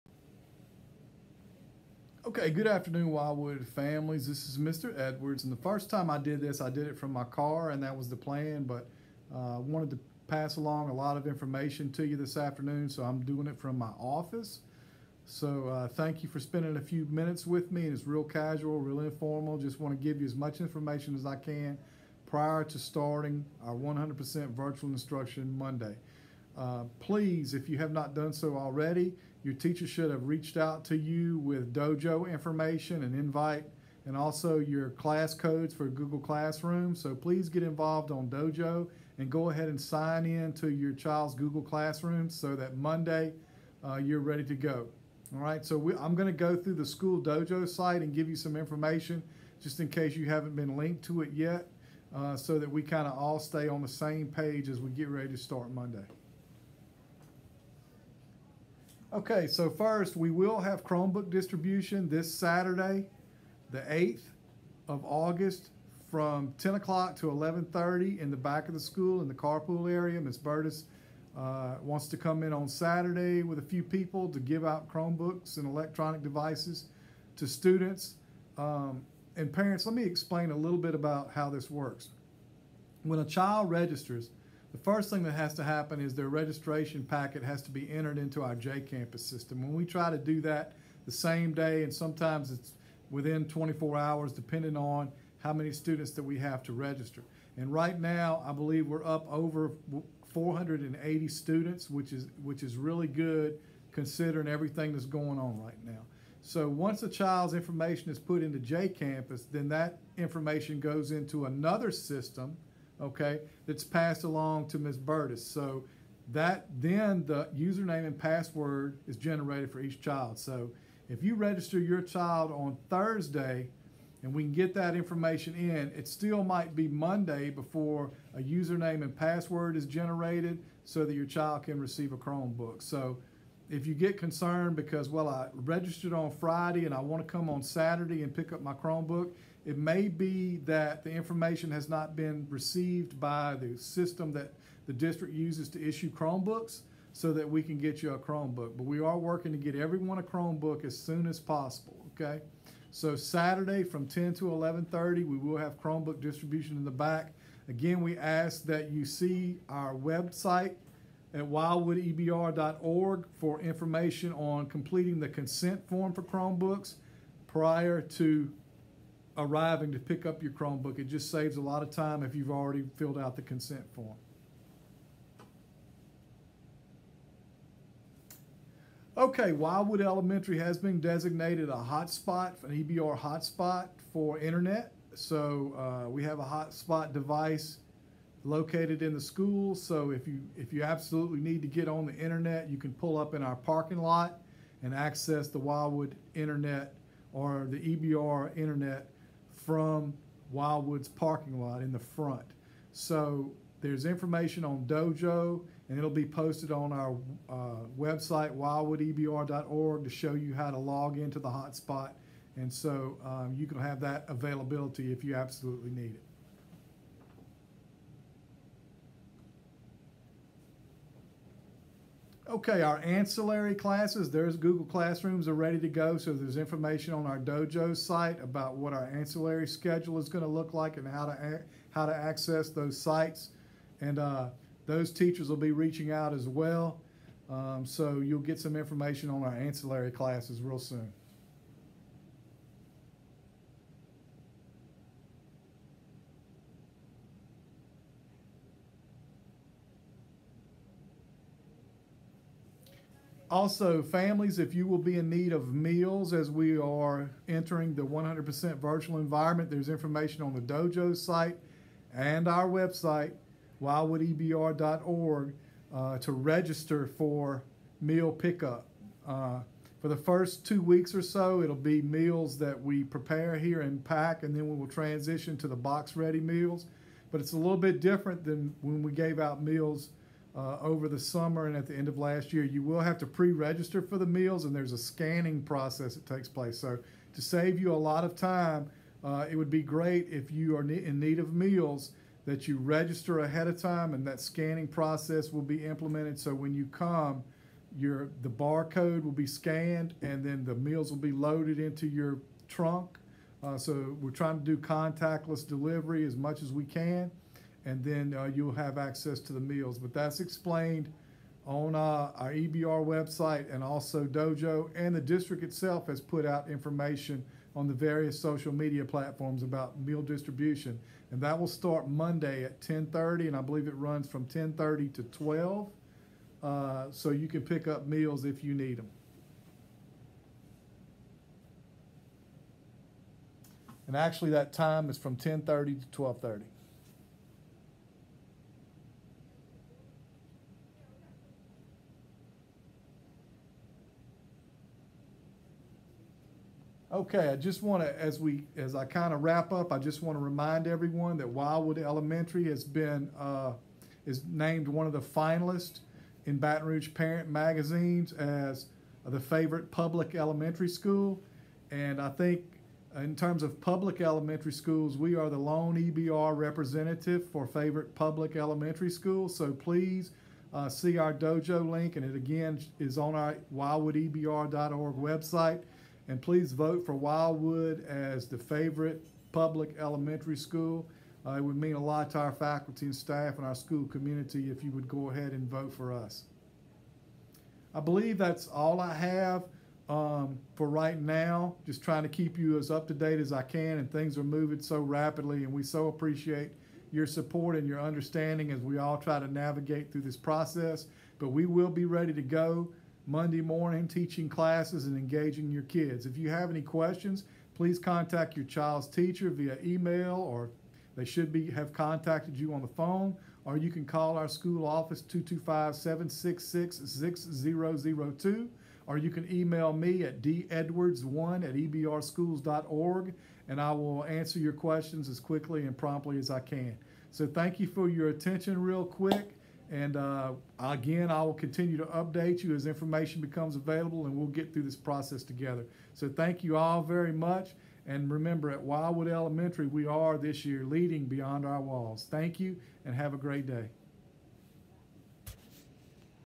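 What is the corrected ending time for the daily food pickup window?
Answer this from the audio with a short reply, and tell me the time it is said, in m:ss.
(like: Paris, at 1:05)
12:30, at 5:36.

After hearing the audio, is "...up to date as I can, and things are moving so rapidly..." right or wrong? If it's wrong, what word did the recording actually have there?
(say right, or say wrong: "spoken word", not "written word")
right.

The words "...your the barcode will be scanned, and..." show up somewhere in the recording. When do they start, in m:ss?
4:57.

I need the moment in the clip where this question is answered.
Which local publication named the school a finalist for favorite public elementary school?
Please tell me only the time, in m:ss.
5:56.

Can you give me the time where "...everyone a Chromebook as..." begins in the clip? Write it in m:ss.
2:29.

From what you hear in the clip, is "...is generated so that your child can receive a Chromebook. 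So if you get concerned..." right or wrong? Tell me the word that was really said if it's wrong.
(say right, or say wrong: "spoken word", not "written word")
right.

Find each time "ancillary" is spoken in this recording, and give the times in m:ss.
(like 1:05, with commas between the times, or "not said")
3:42, 3:49, 3:59.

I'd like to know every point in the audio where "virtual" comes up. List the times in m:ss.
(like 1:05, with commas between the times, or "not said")
0:24, 4:18.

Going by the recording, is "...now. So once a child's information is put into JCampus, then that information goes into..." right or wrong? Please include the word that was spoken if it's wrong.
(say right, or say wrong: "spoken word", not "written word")
right.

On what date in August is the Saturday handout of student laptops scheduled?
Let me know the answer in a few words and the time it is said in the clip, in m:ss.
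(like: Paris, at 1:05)
August 8, at 1:03.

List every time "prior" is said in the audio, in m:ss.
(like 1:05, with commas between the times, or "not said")
0:22, 2:47.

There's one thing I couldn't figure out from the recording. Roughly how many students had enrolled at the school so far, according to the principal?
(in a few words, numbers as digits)
over 480.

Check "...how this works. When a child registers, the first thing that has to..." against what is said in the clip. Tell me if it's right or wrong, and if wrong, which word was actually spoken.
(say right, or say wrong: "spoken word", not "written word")
right.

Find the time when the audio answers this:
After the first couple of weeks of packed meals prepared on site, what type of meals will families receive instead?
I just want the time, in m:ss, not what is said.
4:35.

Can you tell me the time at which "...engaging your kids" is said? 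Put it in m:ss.
6:45.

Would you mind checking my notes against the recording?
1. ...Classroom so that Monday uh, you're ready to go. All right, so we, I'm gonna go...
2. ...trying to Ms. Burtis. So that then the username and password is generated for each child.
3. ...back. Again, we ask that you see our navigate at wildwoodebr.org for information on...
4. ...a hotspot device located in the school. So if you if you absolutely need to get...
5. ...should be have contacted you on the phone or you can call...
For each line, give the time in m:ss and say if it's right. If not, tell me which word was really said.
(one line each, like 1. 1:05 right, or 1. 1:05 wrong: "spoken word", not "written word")
1. 0:41 right
2. 1:54 wrong: "along", not "trying"
3. 2:36 wrong: "website", not "navigate"
4. 3:06 right
5. 6:51 right.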